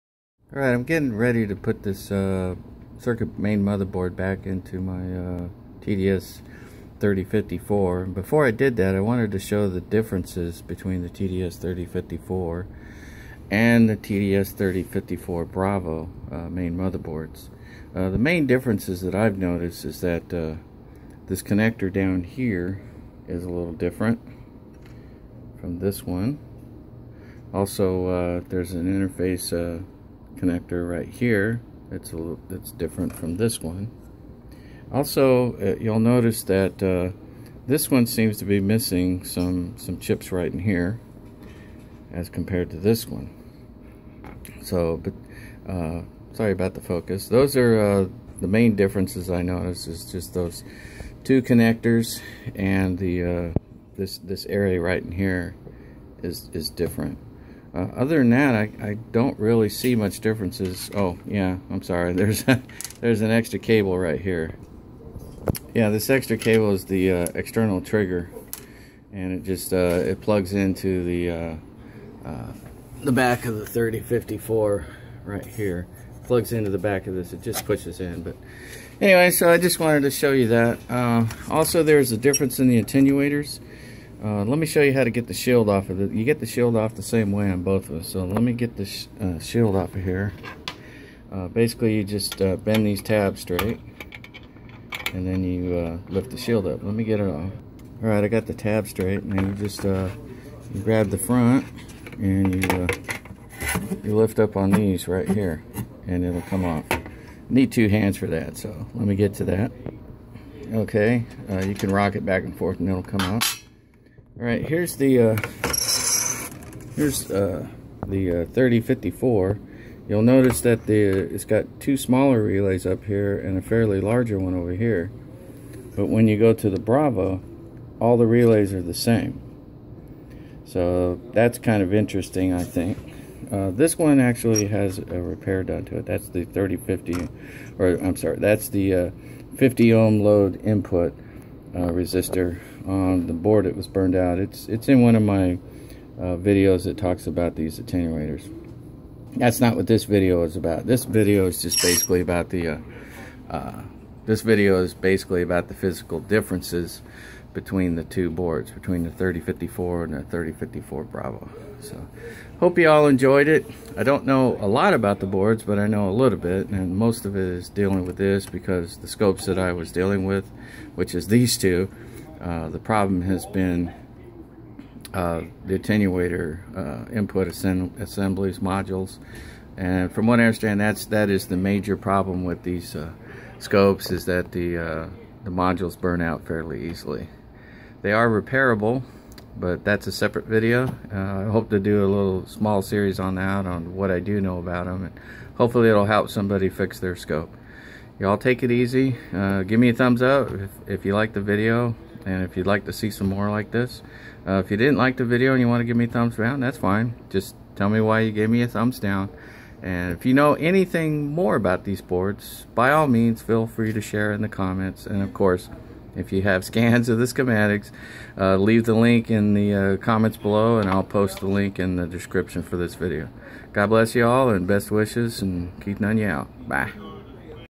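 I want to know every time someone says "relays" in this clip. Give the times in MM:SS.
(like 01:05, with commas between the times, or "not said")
02:02, 02:08.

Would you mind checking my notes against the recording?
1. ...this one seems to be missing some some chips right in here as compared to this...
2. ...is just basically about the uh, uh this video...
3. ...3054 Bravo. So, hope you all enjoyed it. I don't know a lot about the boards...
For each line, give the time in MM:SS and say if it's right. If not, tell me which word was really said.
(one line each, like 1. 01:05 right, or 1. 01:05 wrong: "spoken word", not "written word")
1. 00:37 right
2. 02:31 right
3. 02:40 right.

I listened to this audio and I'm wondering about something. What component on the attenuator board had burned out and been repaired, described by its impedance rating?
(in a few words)
50 ohm load resistor.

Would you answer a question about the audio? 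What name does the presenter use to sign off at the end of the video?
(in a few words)
Keith Noneya.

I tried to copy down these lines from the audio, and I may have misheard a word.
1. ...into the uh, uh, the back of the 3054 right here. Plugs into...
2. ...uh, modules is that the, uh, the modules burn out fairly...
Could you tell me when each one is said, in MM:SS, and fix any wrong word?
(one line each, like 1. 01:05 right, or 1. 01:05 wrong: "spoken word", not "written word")
1. 01:10 right
2. 03:02 wrong: "scopes", not "modules".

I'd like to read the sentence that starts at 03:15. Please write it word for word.
And hopefully it'll help somebody fix their scope.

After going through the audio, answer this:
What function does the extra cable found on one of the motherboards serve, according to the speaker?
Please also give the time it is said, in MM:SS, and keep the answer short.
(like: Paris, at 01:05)
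External trigger, at 01:07.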